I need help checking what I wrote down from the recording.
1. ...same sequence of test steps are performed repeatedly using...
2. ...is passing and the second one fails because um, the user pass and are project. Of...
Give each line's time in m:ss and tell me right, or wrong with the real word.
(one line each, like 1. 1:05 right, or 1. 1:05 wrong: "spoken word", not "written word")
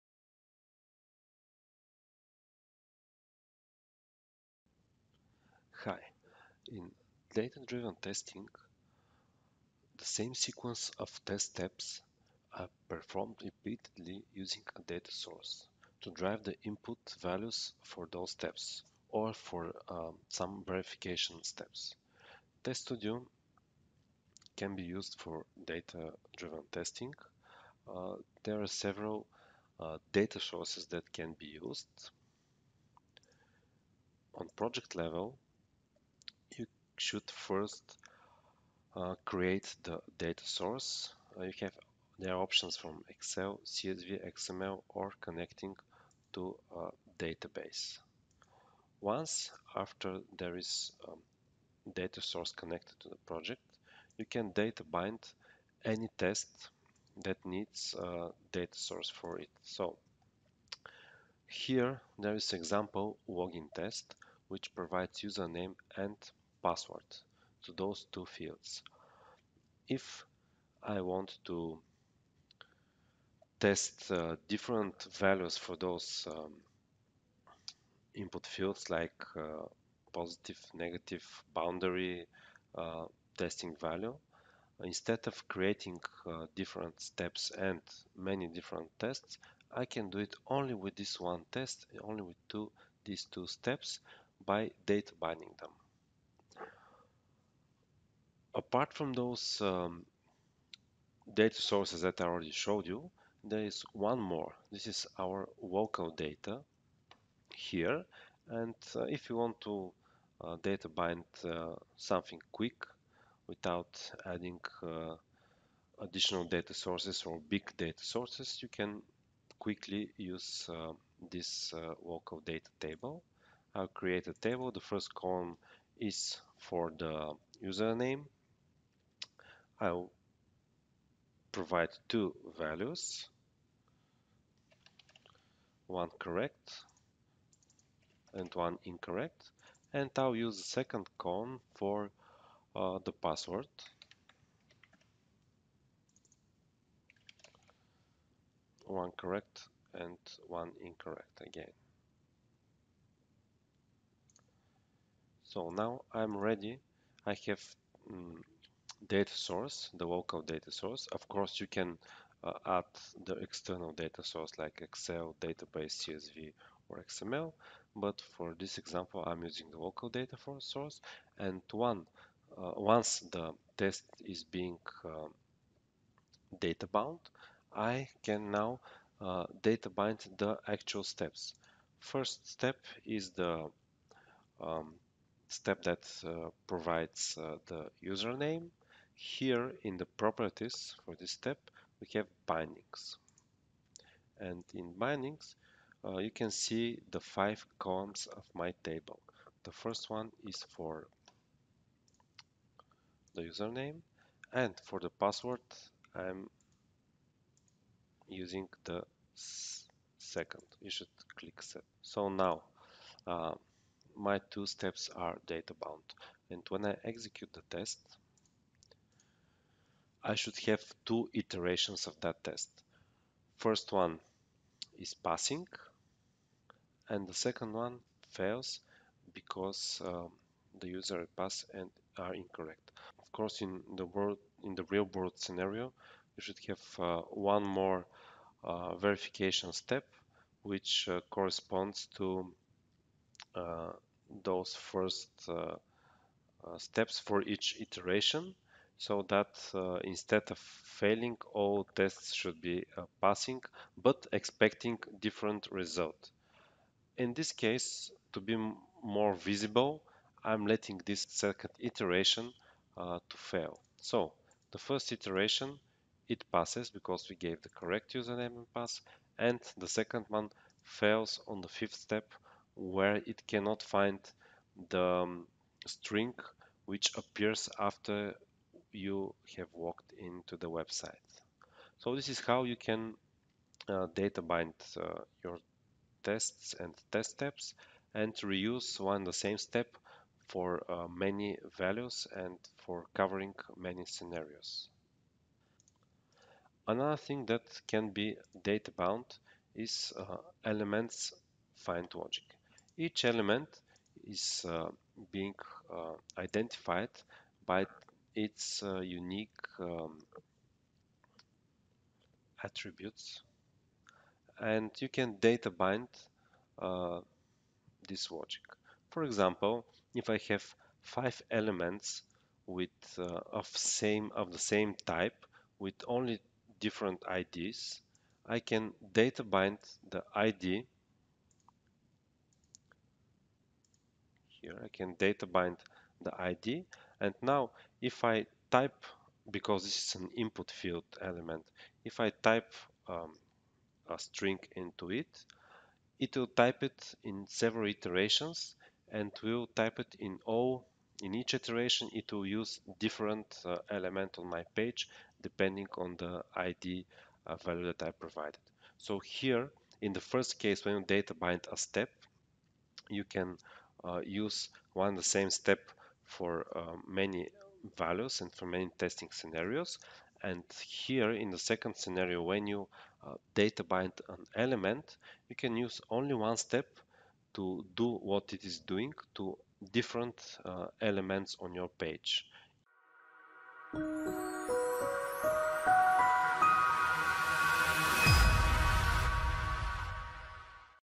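1. 0:10 right
2. 3:44 wrong: "incorrect", not "project".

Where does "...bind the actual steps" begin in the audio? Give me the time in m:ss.
2:59.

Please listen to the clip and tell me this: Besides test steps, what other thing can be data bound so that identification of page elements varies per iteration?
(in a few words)
elements find logic.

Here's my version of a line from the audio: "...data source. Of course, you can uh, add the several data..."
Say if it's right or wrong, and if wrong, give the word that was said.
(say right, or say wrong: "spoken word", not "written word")
wrong: "external", not "several".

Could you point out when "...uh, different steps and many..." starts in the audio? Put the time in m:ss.
1:26.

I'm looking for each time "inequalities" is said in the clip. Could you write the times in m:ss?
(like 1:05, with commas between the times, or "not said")
not said.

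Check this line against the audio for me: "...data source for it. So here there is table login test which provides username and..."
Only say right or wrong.
wrong.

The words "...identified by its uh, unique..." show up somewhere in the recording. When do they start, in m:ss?
5:06.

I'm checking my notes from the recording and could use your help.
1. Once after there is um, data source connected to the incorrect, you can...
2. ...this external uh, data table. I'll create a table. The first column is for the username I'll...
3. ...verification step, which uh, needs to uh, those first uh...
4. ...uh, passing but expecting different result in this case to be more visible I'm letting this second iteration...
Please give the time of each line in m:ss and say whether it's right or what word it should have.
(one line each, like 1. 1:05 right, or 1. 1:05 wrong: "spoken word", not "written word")
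1. 0:48 wrong: "project", not "incorrect"
2. 2:01 wrong: "local", not "external"
3. 3:58 wrong: "corresponds", not "needs"
4. 4:12 right.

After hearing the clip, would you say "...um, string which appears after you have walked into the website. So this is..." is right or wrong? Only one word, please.
right.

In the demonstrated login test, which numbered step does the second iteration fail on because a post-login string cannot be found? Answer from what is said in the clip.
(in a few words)
fifth.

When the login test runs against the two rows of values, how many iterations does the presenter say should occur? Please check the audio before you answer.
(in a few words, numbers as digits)
2.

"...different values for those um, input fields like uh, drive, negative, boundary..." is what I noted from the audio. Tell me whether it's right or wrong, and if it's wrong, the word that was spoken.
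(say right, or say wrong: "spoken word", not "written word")
wrong: "positive", not "drive".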